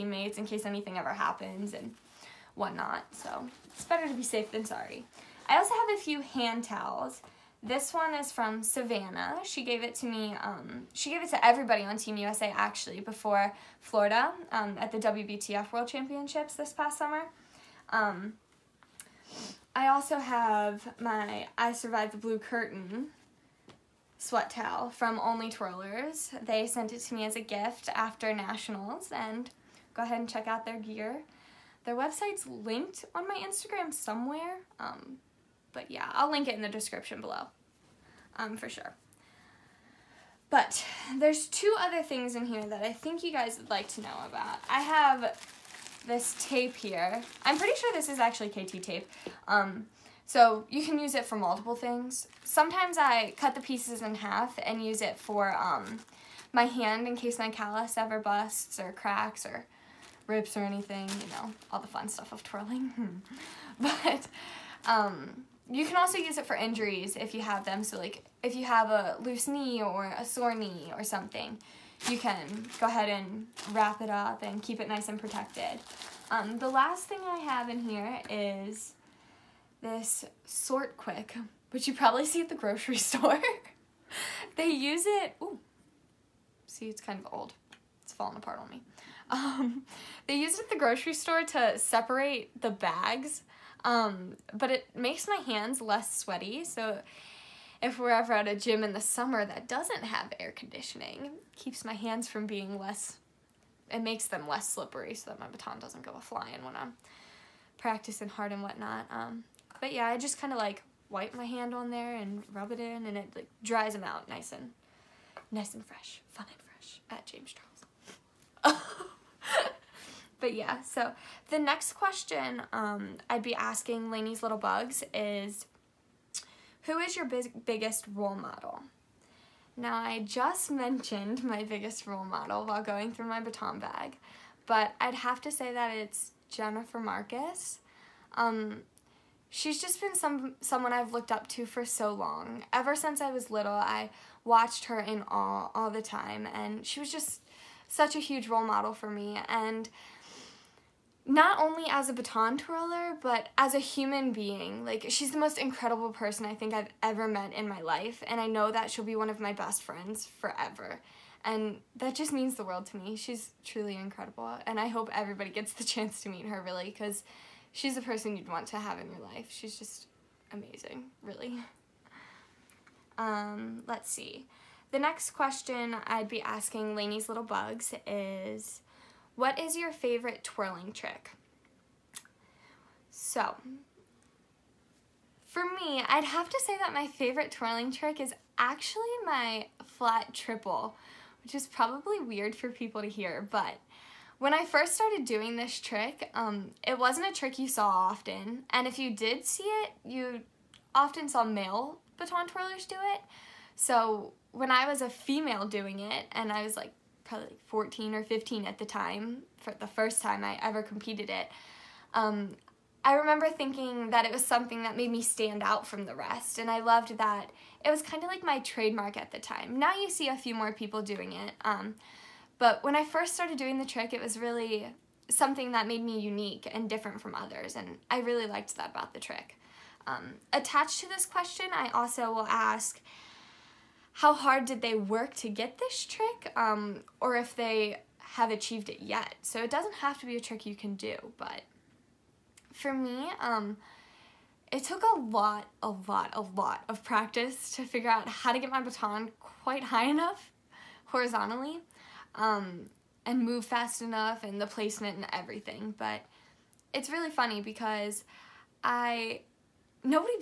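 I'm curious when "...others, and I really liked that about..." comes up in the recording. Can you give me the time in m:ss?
3:47.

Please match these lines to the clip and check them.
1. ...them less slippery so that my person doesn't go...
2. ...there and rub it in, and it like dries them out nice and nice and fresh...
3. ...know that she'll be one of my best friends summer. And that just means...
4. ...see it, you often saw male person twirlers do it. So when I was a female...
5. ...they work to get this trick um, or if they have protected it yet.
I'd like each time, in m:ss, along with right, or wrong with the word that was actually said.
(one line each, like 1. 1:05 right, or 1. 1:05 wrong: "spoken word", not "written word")
1. 1:44 wrong: "baton", not "person"
2. 1:51 right
3. 2:38 wrong: "forever", not "summer"
4. 3:19 wrong: "baton", not "person"
5. 3:54 wrong: "achieved", not "protected".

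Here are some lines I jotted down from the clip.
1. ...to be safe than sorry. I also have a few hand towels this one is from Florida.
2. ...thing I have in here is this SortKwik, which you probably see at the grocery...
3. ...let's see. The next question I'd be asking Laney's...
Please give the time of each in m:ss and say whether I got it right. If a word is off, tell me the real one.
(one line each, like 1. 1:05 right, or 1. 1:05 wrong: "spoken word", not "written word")
1. 0:04 wrong: "Savannah", not "Florida"
2. 1:17 right
3. 2:53 right.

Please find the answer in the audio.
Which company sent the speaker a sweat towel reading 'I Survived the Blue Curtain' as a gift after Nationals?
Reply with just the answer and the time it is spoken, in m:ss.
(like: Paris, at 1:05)
Only Twirlers, at 0:25.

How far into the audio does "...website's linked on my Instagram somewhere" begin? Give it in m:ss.
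0:31.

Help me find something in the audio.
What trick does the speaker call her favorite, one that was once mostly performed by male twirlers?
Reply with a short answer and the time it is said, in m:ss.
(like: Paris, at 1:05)
flat triple, at 3:09.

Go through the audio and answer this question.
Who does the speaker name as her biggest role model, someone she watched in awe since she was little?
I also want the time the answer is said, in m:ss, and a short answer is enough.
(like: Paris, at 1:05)
Jennifer Marcus, at 2:16.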